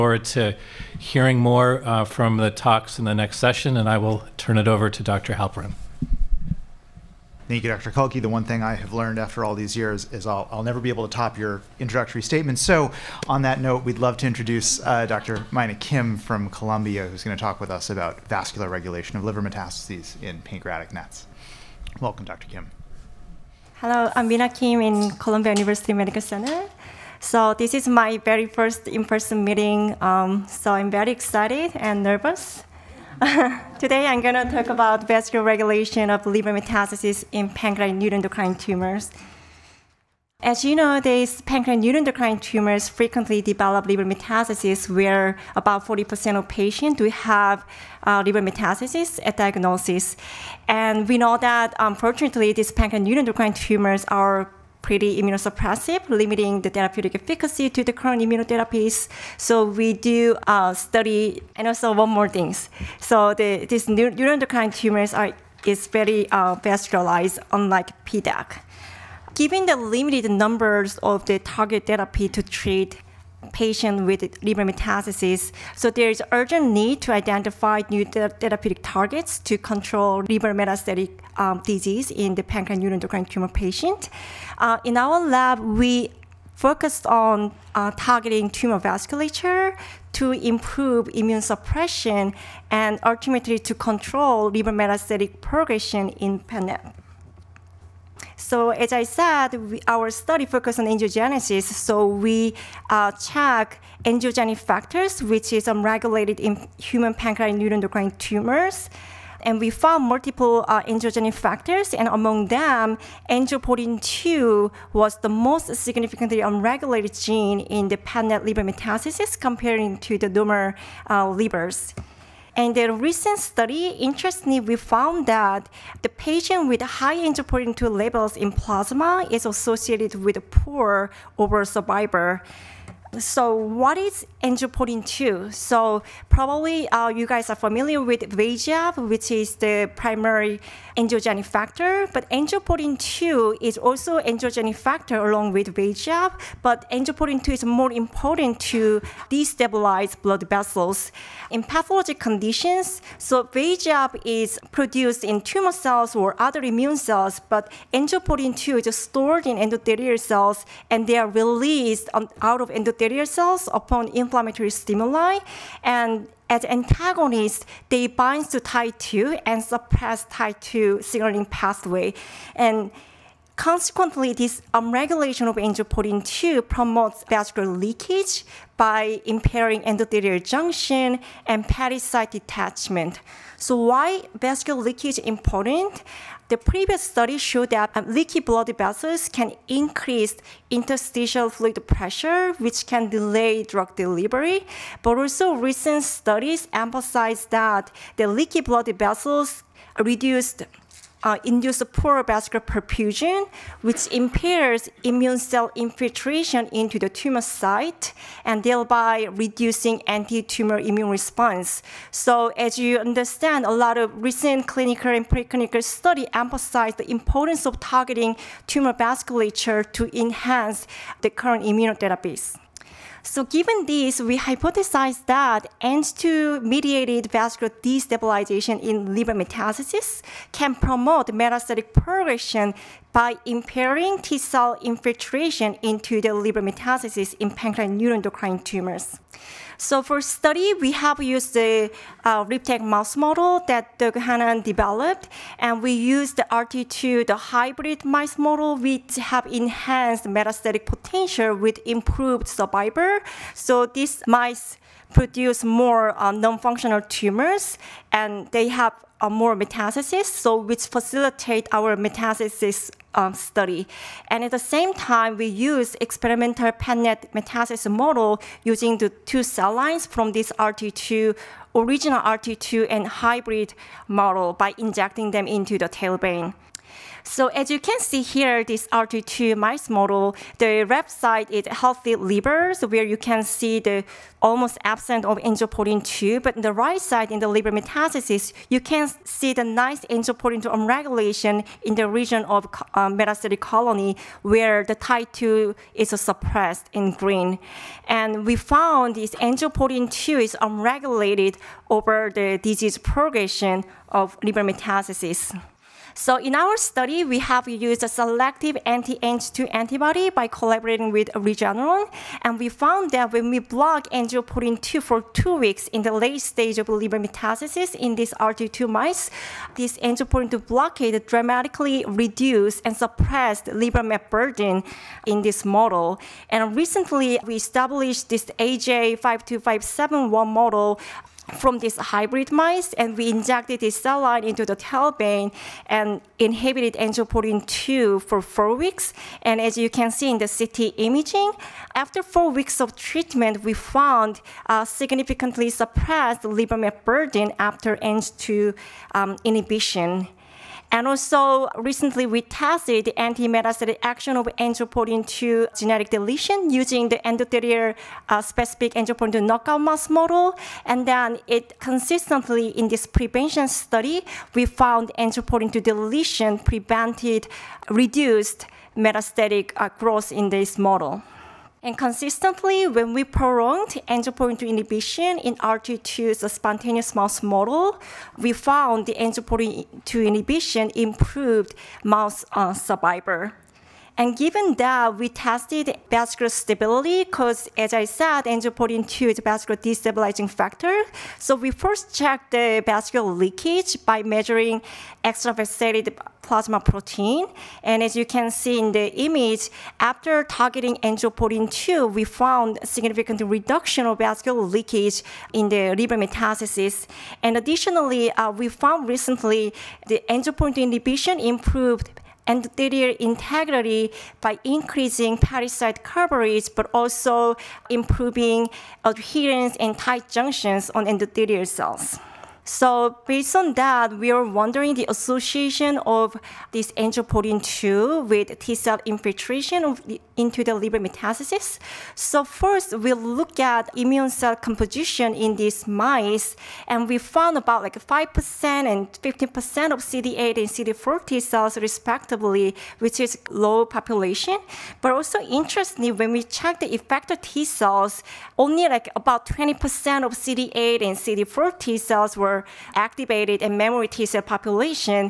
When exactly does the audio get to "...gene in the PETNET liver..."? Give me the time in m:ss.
1:57.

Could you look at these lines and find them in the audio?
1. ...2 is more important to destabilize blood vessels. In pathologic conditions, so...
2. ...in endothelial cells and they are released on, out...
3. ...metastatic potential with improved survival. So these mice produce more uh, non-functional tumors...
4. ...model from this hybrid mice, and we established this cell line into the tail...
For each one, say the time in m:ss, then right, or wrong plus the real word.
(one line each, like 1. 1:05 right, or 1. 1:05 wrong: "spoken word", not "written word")
1. 2:27 right
2. 2:39 right
3. 4:10 right
4. 5:30 wrong: "injected", not "established".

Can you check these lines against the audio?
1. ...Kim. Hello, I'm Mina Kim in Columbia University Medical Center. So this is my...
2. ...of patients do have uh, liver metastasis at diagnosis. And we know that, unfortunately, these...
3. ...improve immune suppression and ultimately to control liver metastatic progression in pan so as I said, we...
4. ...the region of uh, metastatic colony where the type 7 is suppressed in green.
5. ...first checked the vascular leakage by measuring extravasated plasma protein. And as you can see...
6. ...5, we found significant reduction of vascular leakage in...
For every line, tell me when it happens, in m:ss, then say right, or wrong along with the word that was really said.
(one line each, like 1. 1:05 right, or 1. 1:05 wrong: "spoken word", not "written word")
1. 0:22 right
2. 0:46 right
3. 1:30 right
4. 4:51 wrong: "2", not "7"
5. 6:31 right
6. 6:41 wrong: "2", not "5".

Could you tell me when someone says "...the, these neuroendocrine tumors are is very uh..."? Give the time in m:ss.
1:03.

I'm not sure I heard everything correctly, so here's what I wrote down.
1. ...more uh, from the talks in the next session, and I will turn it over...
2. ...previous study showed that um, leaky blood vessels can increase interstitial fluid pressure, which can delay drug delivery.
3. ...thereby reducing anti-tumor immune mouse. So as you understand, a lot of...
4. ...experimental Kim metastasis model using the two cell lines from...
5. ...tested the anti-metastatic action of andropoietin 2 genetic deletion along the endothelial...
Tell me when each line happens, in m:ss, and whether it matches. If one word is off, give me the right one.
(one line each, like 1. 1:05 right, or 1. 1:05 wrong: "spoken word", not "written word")
1. 0:01 right
2. 3:06 right
3. 3:28 wrong: "response", not "mouse"
4. 4:26 wrong: "PANET", not "Kim"
5. 5:52 wrong: "using", not "along".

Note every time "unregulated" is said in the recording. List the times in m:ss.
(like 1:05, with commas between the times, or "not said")
1:45, 1:56, 5:00.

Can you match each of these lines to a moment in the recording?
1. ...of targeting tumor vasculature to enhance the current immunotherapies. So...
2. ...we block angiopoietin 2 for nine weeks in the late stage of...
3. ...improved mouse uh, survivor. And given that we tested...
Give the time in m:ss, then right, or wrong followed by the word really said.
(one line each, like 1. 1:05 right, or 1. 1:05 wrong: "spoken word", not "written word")
1. 3:37 right
2. 5:13 wrong: "two", not "nine"
3. 6:20 right.